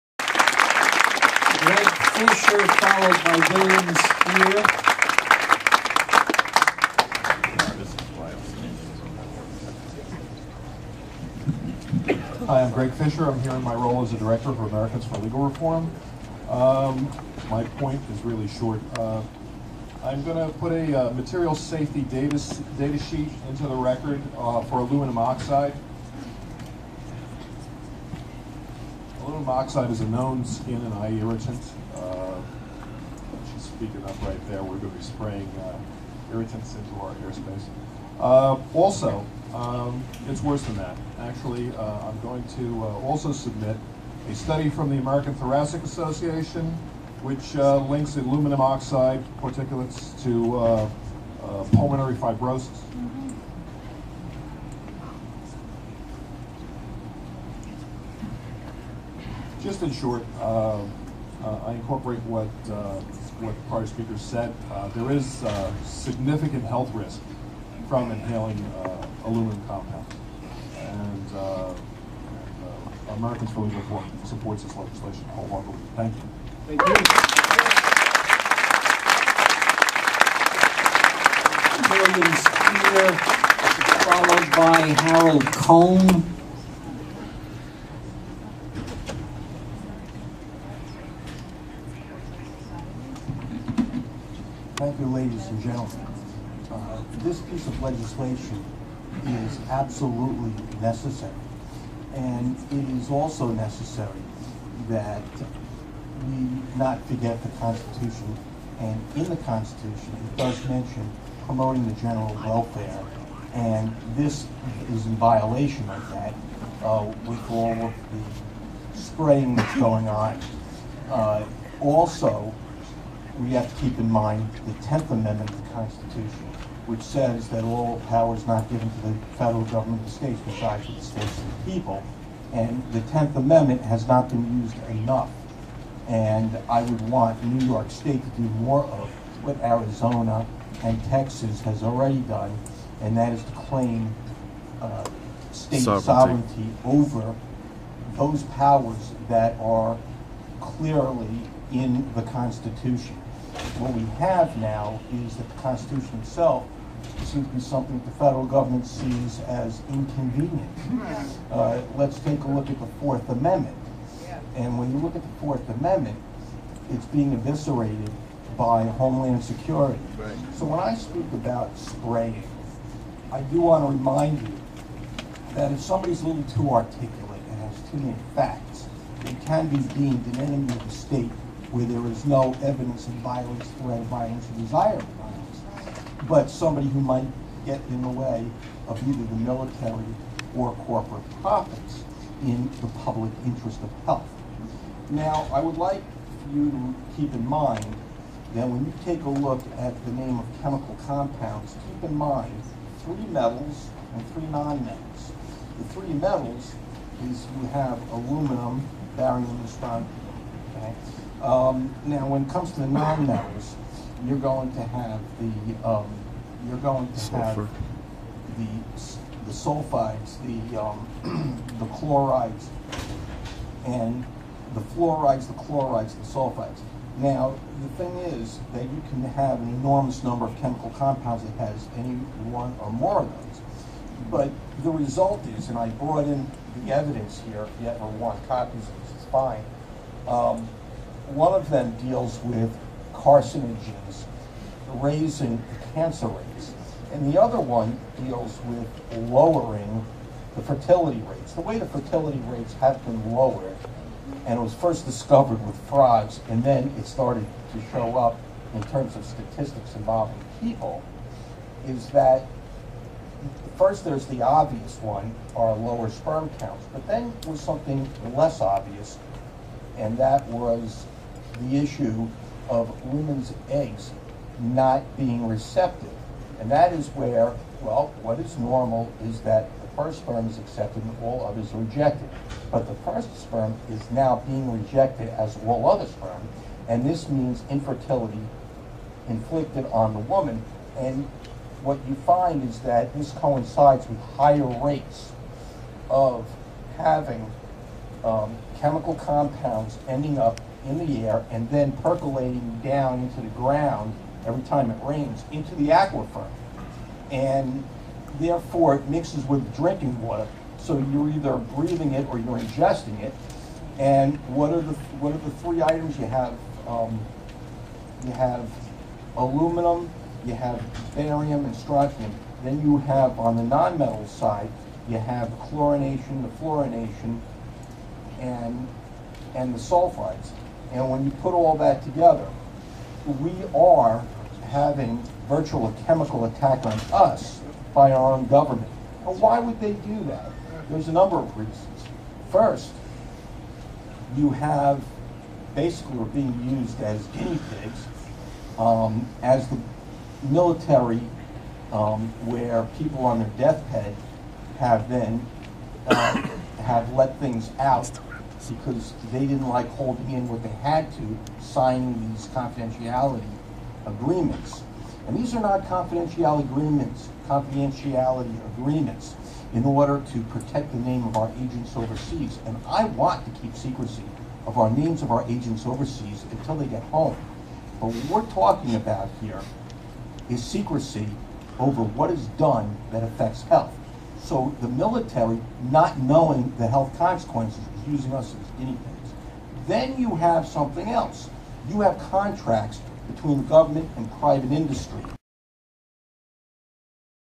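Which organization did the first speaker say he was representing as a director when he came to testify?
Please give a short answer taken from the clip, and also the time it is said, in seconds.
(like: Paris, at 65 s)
Americans for Legal Reform, at 14 s.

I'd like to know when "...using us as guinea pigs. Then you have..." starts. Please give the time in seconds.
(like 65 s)
388 s.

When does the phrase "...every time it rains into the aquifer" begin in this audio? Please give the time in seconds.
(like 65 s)
304 s.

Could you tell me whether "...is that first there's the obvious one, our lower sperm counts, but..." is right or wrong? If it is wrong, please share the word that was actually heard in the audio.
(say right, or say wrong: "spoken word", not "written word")
right.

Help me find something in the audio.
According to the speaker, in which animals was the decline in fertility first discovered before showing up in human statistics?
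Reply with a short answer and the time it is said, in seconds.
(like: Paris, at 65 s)
frogs, at 255 s.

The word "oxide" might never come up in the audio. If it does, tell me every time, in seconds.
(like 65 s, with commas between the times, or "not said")
25 s, 29 s, 48 s.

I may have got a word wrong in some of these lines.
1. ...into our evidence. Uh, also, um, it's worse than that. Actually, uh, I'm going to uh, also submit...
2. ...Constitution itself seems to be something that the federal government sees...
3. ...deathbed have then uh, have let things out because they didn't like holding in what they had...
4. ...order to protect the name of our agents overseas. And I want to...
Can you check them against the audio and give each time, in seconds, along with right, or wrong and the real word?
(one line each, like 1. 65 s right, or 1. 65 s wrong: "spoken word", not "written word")
1. 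36 s wrong: "airspace", not "evidence"
2. 155 s right
3. 353 s right
4. 369 s right.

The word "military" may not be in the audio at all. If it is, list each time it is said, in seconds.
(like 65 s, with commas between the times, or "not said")
189 s, 350 s, 384 s.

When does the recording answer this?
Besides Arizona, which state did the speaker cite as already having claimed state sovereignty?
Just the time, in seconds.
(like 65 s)
141 s.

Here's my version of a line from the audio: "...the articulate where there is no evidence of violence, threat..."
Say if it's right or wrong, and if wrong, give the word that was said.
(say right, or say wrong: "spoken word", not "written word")
wrong: "state", not "articulate".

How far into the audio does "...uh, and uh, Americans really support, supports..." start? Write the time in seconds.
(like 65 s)
71 s.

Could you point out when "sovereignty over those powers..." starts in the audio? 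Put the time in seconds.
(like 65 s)
146 s.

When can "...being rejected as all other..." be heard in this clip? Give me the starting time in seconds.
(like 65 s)
284 s.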